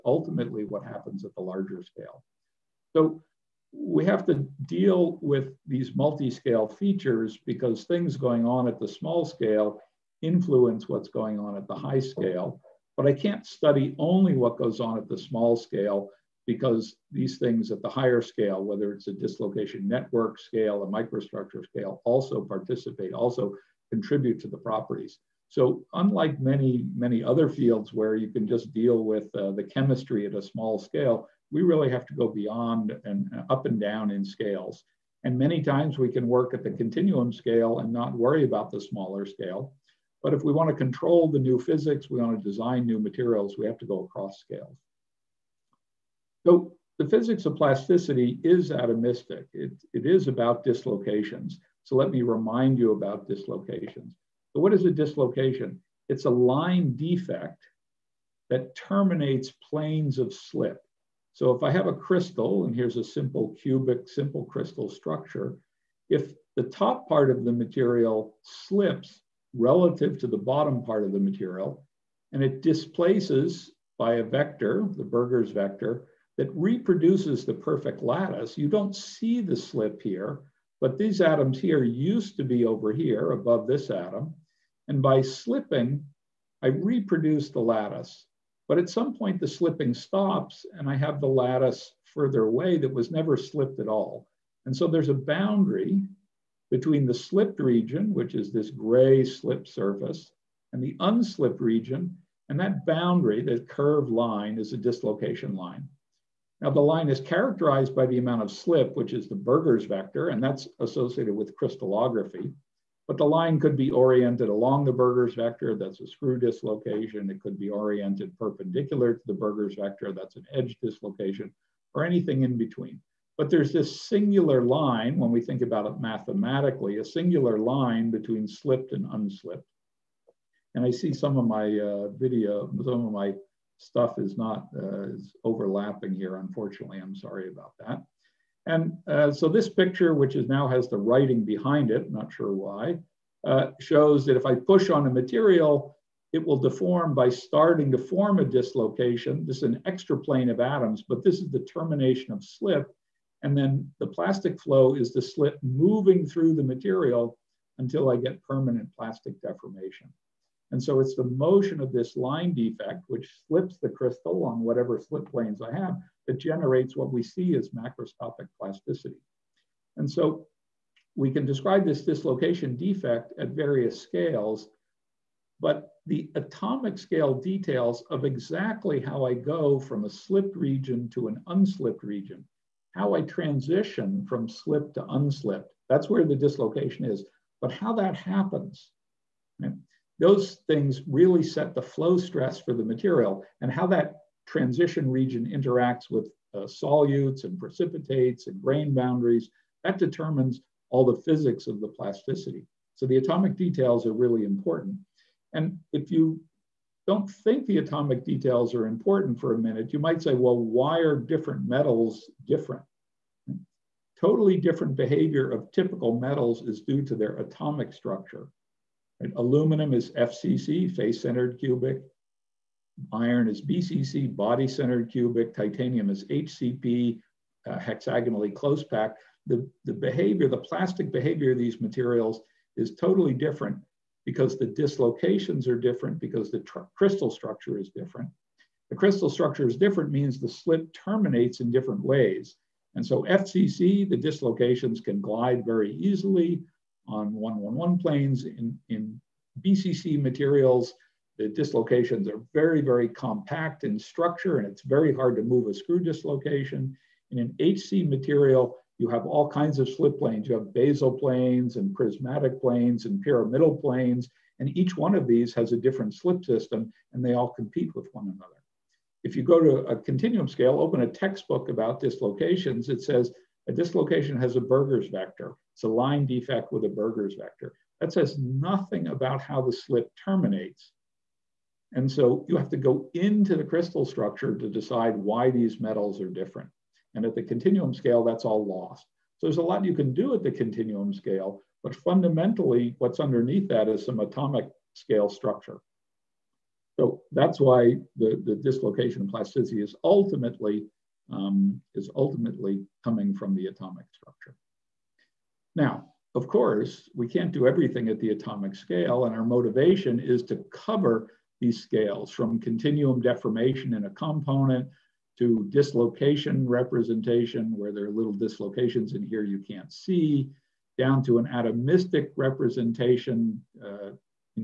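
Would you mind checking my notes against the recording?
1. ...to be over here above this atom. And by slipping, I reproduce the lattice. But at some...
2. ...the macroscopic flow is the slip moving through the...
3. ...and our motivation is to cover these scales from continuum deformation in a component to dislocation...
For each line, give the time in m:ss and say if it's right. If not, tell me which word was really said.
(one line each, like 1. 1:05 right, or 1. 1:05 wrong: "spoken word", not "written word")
1. 1:22 right
2. 2:33 wrong: "plastic", not "macroscopic"
3. 5:09 right.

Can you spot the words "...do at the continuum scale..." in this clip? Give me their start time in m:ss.
4:50.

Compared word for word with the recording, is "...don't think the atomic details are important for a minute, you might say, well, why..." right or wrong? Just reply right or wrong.
right.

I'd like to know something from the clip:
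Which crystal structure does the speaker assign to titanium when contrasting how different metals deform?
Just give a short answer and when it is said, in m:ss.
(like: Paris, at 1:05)
hexagonally close packed, at 3:47.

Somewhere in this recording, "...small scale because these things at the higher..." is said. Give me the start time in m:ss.
0:15.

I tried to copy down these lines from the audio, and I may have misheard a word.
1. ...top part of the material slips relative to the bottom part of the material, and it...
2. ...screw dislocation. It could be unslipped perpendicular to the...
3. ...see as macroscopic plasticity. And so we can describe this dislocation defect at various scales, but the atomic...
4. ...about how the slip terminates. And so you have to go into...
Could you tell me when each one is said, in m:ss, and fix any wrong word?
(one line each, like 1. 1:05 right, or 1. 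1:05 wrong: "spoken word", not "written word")
1. 1:06 right
2. 1:56 wrong: "oriented", not "unslipped"
3. 2:47 right
4. 4:39 right.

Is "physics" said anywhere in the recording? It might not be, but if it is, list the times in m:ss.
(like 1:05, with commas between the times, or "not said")
0:41, 0:47, 3:21.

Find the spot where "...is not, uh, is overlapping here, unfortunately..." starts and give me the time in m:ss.
2:14.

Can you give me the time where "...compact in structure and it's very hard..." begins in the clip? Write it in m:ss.
4:13.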